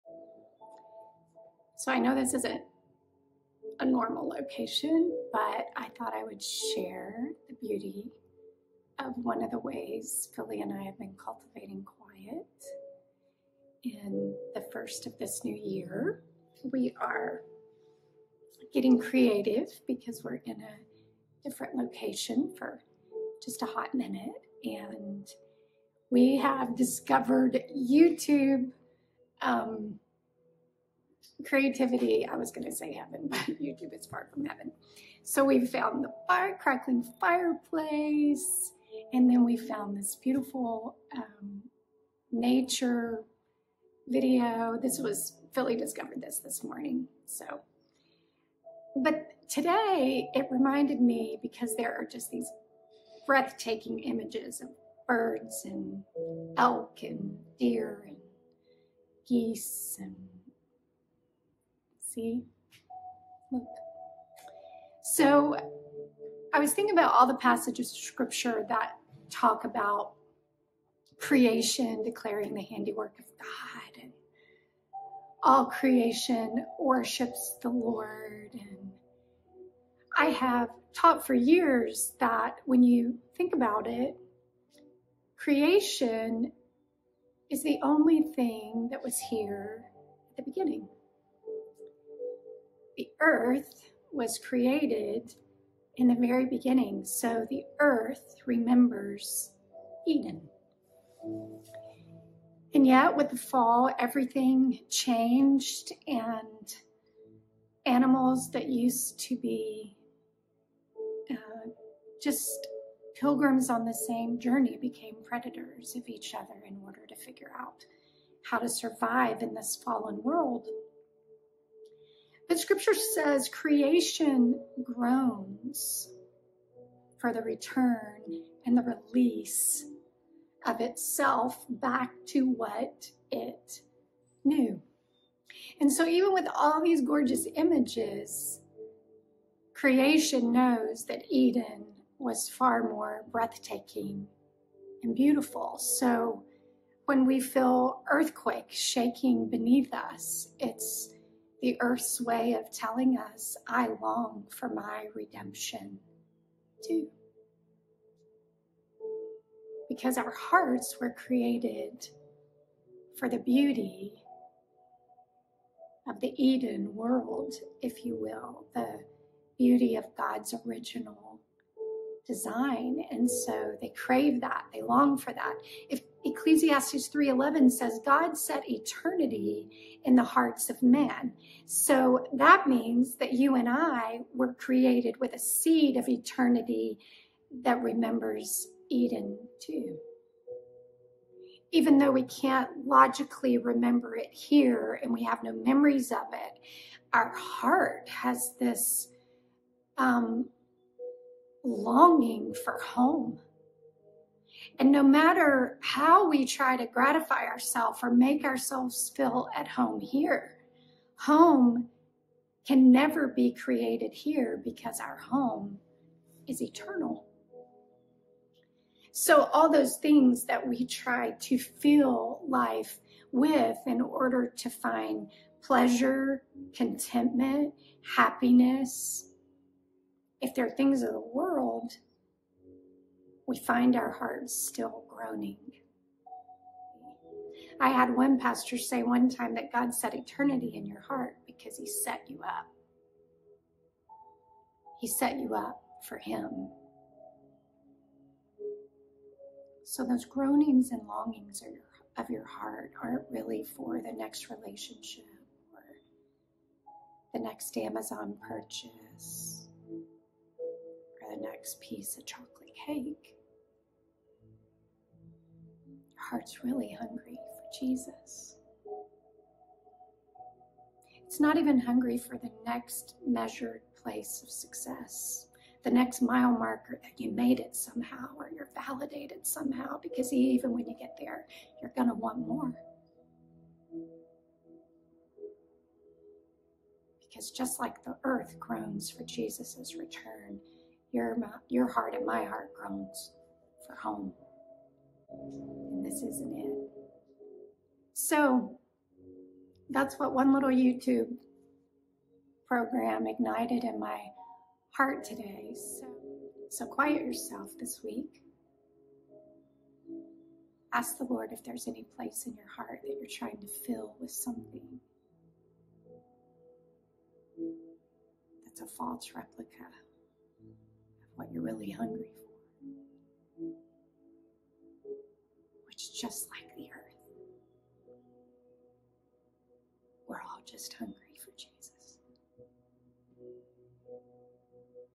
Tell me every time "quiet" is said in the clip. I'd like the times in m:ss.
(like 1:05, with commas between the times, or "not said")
0:11, 5:06.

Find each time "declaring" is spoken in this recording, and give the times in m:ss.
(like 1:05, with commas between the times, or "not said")
1:12.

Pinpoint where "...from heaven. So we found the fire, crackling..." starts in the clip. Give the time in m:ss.
0:34.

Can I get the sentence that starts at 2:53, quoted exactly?
And so they crave that, they long for that.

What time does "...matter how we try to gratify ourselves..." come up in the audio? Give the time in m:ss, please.
3:25.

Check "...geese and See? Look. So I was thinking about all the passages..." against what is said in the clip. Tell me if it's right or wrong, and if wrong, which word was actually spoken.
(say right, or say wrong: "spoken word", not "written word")
right.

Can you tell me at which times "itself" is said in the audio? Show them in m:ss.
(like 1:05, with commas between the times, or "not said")
2:10.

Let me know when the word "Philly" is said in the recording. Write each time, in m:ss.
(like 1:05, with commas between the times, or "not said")
0:10, 0:45.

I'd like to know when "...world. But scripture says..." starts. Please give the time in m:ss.
2:00.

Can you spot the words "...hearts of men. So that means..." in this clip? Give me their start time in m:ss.
3:00.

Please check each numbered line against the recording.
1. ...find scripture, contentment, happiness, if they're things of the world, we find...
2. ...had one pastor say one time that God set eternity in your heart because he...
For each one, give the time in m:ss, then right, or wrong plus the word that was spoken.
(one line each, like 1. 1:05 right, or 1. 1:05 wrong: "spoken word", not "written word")
1. 3:44 wrong: "pleasure", not "scripture"
2. 3:57 right.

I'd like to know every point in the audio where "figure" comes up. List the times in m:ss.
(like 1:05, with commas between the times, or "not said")
1:57.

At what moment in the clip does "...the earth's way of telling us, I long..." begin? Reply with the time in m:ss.
2:31.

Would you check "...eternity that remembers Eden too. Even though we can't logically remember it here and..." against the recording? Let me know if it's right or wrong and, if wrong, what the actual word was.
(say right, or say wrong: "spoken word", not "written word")
right.